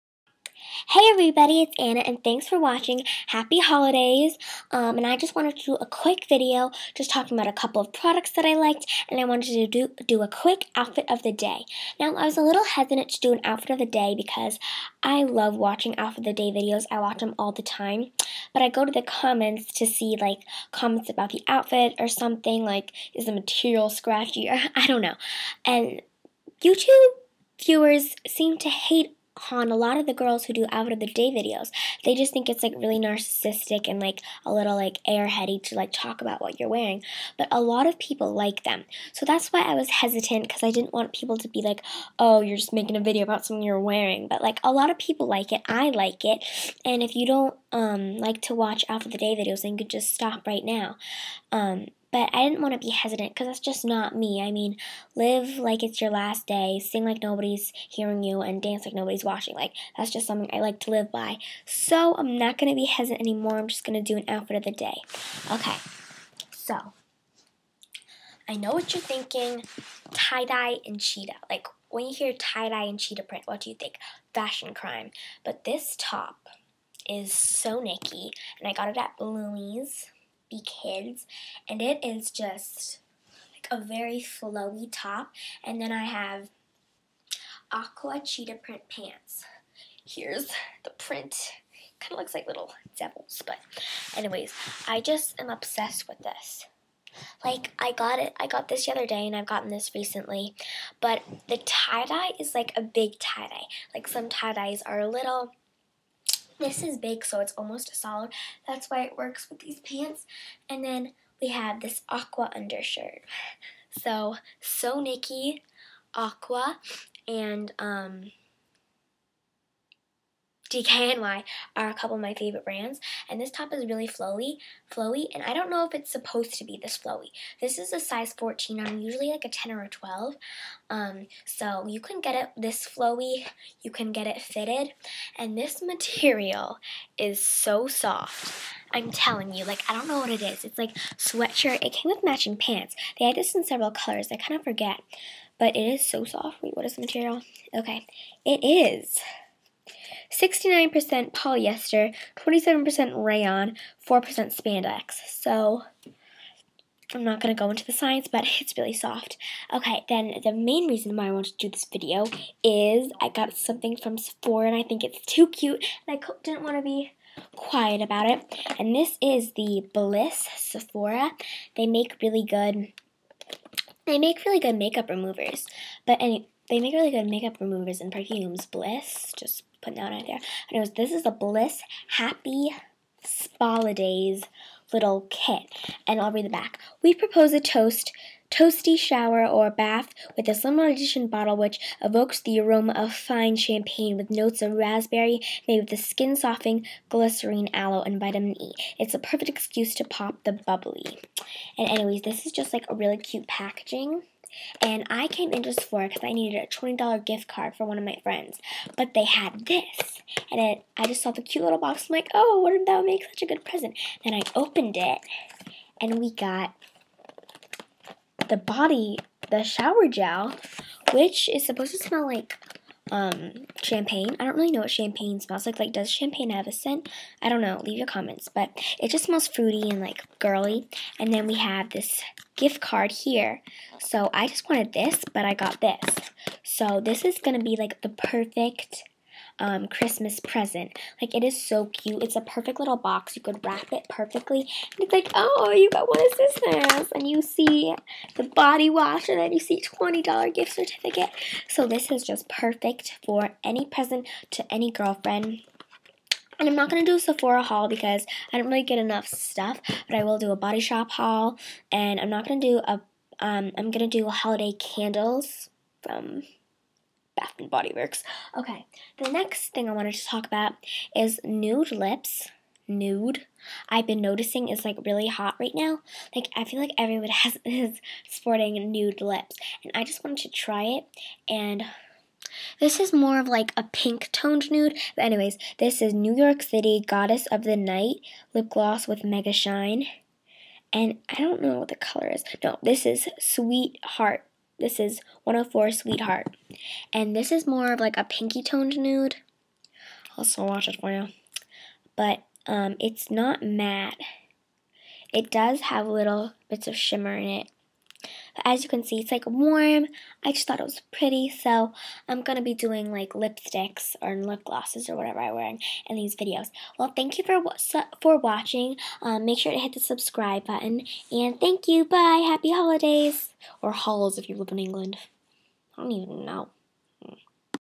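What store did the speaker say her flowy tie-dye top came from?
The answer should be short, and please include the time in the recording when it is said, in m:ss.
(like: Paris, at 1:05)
Bloomie's Be Kids, at 1:19.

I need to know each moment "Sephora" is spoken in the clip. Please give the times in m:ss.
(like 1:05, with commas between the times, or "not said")
2:44, 2:50, 3:25, 4:17.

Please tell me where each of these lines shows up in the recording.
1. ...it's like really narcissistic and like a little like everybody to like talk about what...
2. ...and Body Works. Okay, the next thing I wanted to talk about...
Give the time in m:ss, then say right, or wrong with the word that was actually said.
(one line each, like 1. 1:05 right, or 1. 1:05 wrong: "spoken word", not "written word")
1. 0:32 wrong: "airheady", not "everybody"
2. 4:27 right.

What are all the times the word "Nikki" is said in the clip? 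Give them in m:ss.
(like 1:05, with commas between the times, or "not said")
1:17, 1:55.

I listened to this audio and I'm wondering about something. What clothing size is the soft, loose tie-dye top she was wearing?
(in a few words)
14.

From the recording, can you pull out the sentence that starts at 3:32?
I'm like, oh, wouldn't that make such a good present?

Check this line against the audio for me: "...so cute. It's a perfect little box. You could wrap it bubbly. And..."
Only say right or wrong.
wrong.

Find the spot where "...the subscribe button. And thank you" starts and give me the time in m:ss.
5:19.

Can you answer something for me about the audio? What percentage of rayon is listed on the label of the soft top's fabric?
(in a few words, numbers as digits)
27%.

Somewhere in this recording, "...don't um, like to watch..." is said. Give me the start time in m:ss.
0:47.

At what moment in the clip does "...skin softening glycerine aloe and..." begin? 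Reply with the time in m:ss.
3:15.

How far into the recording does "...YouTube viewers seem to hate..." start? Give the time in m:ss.
0:26.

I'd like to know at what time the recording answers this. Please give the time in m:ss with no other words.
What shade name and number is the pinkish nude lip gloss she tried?
4:55.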